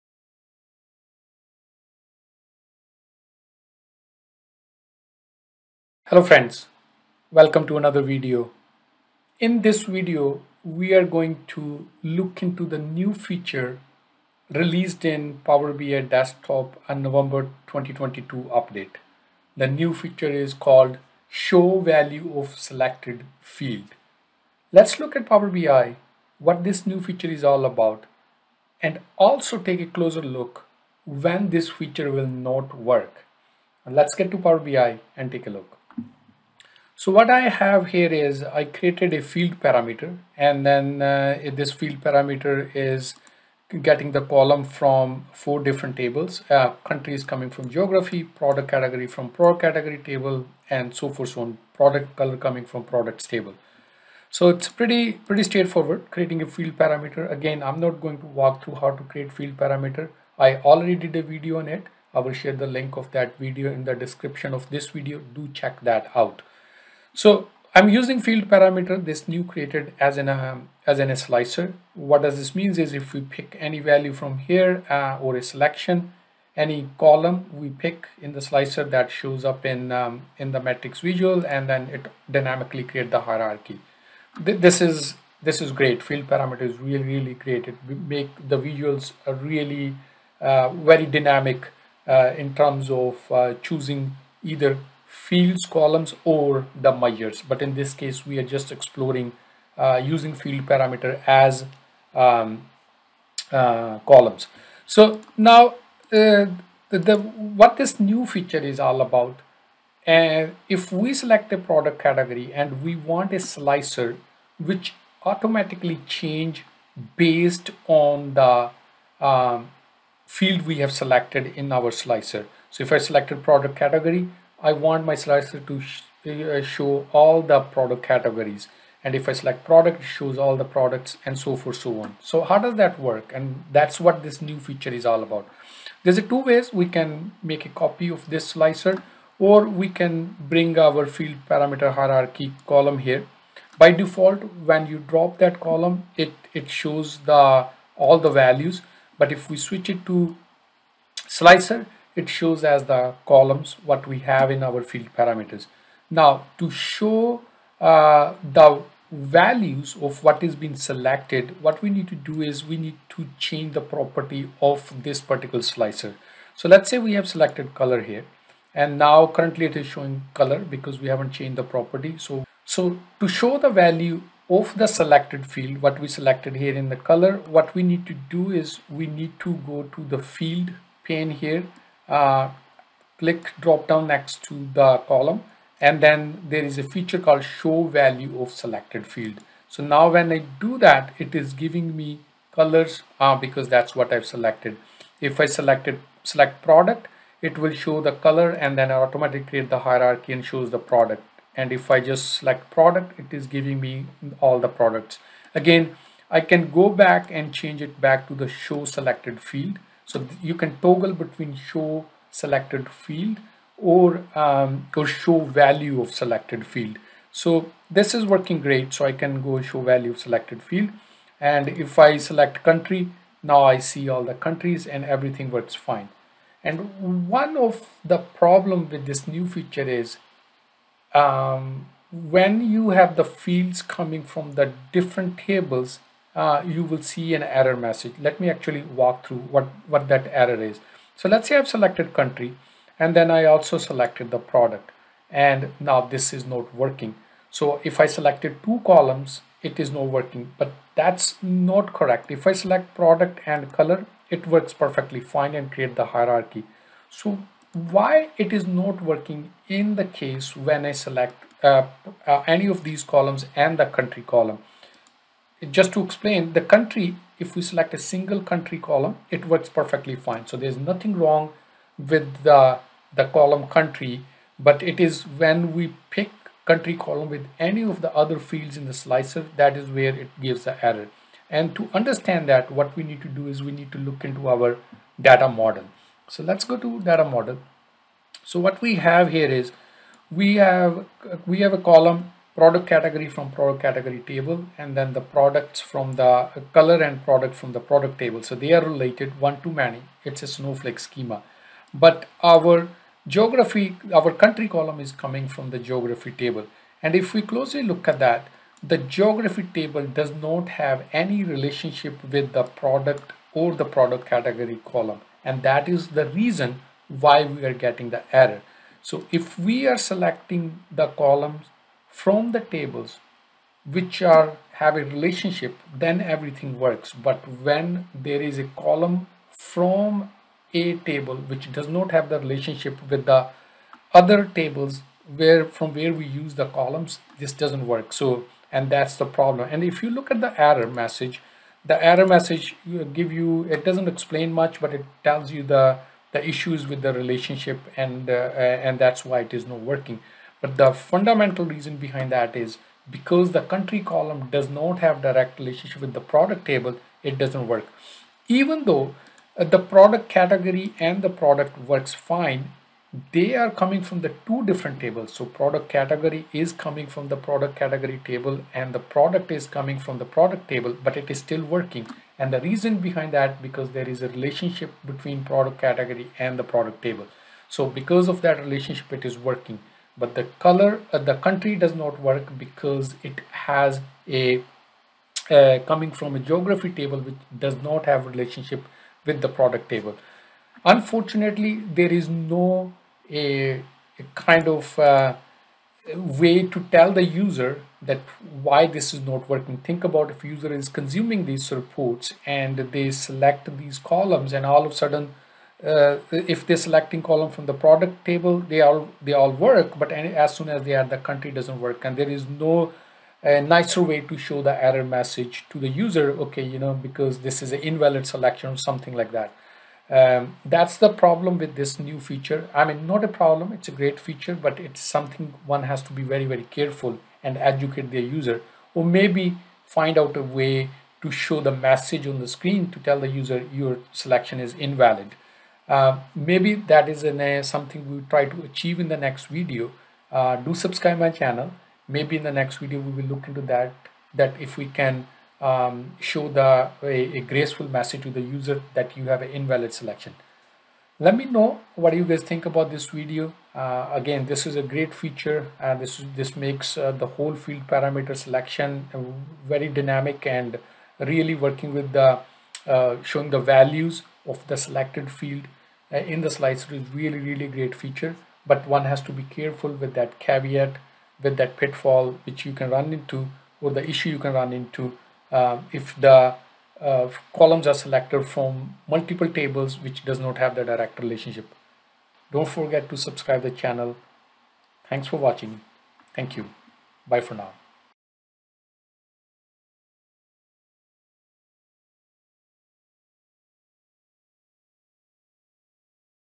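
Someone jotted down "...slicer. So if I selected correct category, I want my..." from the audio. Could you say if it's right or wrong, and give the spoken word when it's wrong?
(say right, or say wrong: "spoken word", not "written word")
wrong: "product", not "correct".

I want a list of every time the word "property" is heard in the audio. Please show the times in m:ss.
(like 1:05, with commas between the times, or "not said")
2:43, 2:51.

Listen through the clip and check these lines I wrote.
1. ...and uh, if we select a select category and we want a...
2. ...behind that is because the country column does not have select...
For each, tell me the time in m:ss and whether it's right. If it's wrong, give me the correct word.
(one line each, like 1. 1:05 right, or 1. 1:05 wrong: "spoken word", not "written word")
1. 1:50 wrong: "product", not "select"
2. 5:51 wrong: "direct", not "select".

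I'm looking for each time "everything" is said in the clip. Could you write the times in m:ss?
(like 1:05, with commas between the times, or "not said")
3:45, 5:26.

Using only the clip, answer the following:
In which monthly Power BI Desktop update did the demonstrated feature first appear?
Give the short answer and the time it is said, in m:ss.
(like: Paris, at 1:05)
November 2022, at 0:17.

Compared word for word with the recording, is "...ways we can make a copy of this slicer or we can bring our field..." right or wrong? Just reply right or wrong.
right.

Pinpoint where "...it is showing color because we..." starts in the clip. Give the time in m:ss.
2:49.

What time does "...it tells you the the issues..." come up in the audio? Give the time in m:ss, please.
5:44.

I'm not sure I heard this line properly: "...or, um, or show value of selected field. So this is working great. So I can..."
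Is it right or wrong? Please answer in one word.
right.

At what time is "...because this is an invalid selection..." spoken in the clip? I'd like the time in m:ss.
6:56.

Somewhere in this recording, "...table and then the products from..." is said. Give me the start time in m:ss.
4:54.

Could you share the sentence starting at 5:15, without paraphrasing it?
And that is the reason why we are getting the error.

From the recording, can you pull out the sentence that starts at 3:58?
Let me actually walk through what, what that error is.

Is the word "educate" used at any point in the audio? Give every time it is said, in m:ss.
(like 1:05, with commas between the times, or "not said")
7:07.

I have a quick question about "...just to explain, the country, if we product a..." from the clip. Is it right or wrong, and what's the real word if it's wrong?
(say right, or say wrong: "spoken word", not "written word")
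wrong: "select", not "product".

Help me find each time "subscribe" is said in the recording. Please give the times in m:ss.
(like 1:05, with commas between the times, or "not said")
7:20, 8:03.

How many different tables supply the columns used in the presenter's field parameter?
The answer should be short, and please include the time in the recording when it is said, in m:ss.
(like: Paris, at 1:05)
4, at 0:45.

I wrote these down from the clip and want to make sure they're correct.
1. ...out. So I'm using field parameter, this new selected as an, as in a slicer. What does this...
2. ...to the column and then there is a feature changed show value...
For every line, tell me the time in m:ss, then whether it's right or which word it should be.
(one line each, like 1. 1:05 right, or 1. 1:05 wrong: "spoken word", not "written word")
1. 1:06 wrong: "created", not "selected"
2. 3:04 wrong: "called", not "changed".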